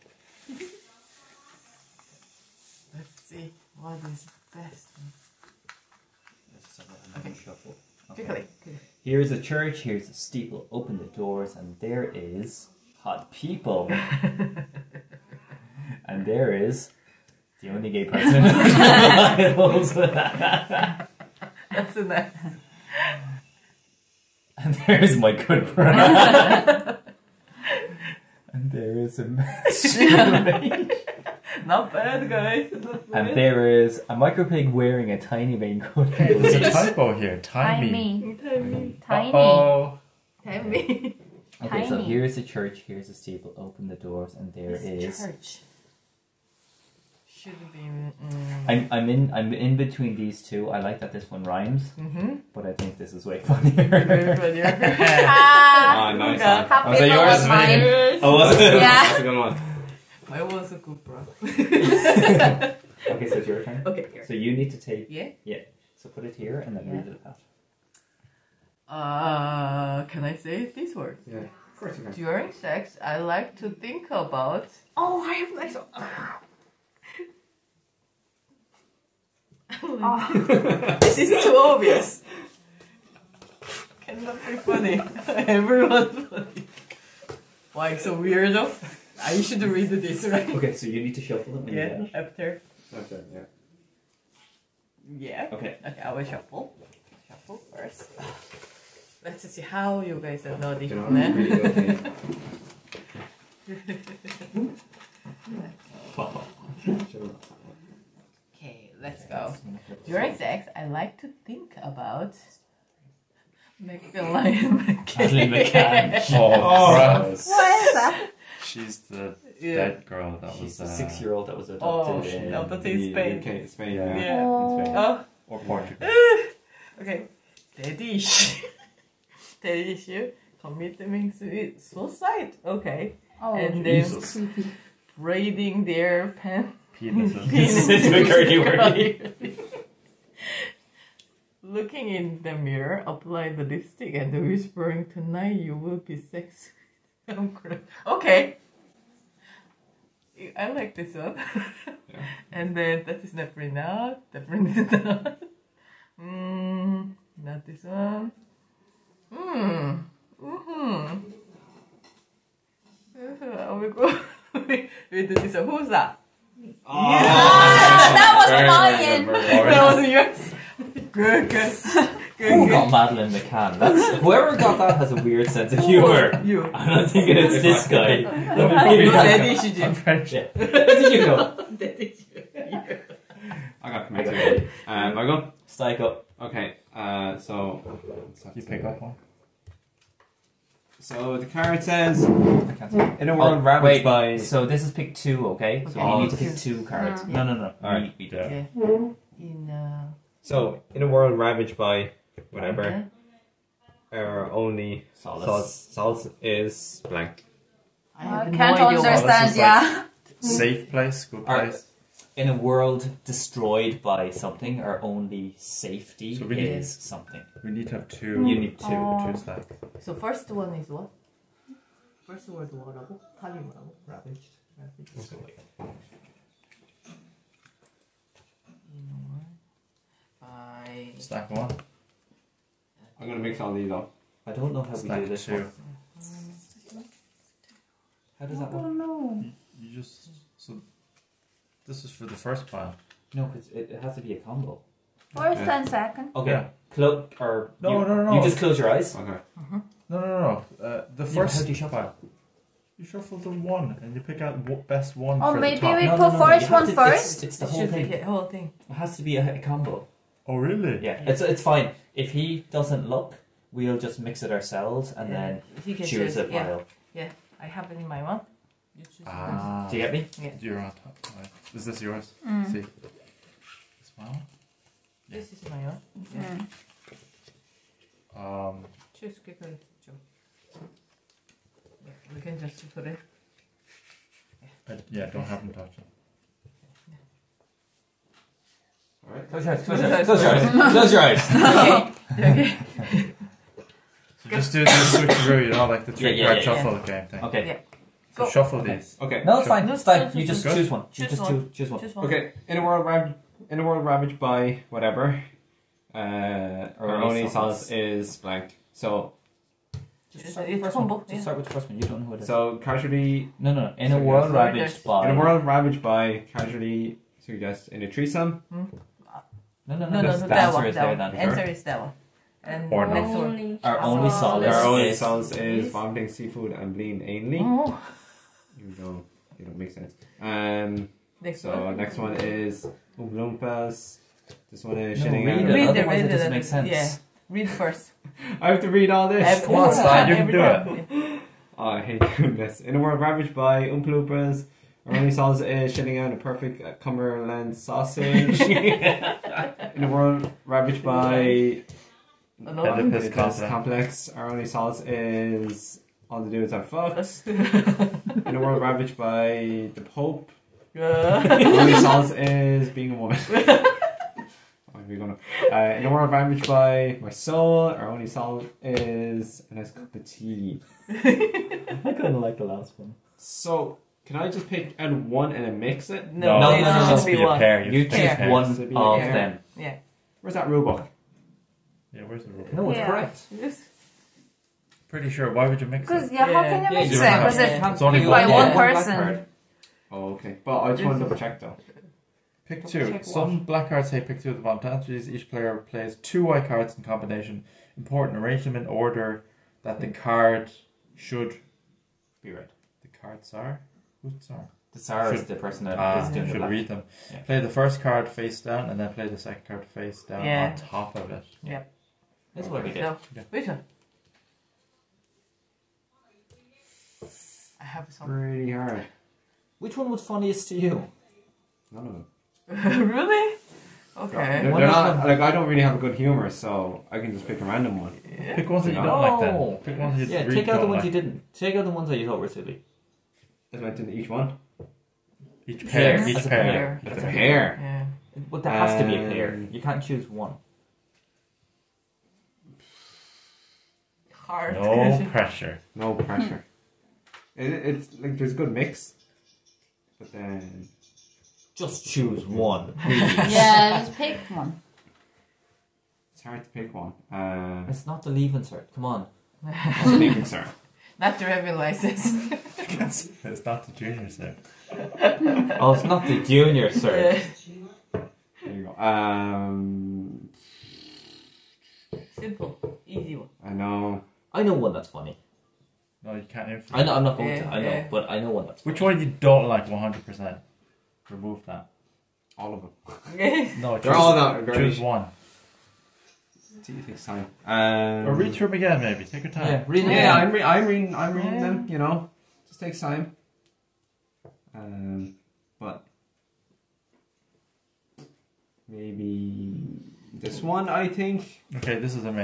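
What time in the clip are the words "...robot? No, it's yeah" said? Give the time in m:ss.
6:22.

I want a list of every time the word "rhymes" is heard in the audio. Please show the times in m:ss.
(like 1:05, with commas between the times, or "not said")
0:51.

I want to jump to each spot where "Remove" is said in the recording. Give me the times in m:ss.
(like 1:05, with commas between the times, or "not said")
8:01.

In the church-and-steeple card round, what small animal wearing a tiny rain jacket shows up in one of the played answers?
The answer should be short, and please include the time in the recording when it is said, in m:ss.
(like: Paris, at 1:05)
micro pig, at 0:34.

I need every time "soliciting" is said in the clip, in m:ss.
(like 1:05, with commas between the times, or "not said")
not said.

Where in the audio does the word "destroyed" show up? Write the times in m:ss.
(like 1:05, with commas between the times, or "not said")
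3:33.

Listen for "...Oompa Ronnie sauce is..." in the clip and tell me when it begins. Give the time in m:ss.
5:43.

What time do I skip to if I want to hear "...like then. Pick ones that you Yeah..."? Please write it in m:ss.
7:09.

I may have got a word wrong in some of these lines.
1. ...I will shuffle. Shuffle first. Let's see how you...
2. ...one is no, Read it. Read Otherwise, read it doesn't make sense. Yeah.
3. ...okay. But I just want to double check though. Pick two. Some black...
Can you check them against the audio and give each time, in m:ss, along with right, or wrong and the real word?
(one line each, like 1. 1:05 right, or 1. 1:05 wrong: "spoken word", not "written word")
1. 1:36 right
2. 5:34 right
3. 6:30 right.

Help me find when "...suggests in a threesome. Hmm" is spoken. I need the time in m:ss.
5:17.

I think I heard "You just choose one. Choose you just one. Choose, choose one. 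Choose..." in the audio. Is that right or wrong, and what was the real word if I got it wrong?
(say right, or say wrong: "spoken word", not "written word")
right.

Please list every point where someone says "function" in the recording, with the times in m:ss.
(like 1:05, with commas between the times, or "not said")
not said.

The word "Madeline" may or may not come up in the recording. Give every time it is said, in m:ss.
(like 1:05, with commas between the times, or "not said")
2:52.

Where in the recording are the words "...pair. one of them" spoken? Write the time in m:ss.
6:18.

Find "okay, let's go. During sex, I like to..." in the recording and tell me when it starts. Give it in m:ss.
1:48.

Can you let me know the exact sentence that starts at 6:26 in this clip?
Because yeah, how can you mix it?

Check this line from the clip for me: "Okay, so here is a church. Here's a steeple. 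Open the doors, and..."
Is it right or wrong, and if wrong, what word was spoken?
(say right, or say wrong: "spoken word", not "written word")
right.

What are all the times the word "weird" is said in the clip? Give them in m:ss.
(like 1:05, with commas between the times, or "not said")
1:28, 2:55.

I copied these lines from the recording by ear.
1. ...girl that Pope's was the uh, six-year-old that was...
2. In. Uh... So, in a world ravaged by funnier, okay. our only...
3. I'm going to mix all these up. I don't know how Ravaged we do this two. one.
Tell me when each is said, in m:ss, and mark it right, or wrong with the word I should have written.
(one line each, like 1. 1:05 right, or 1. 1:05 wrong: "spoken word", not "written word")
1. 2:00 wrong: "She", not "Pope"
2. 3:19 wrong: "whatever", not "funnier"
3. 3:53 wrong: "Stack", not "Ravaged".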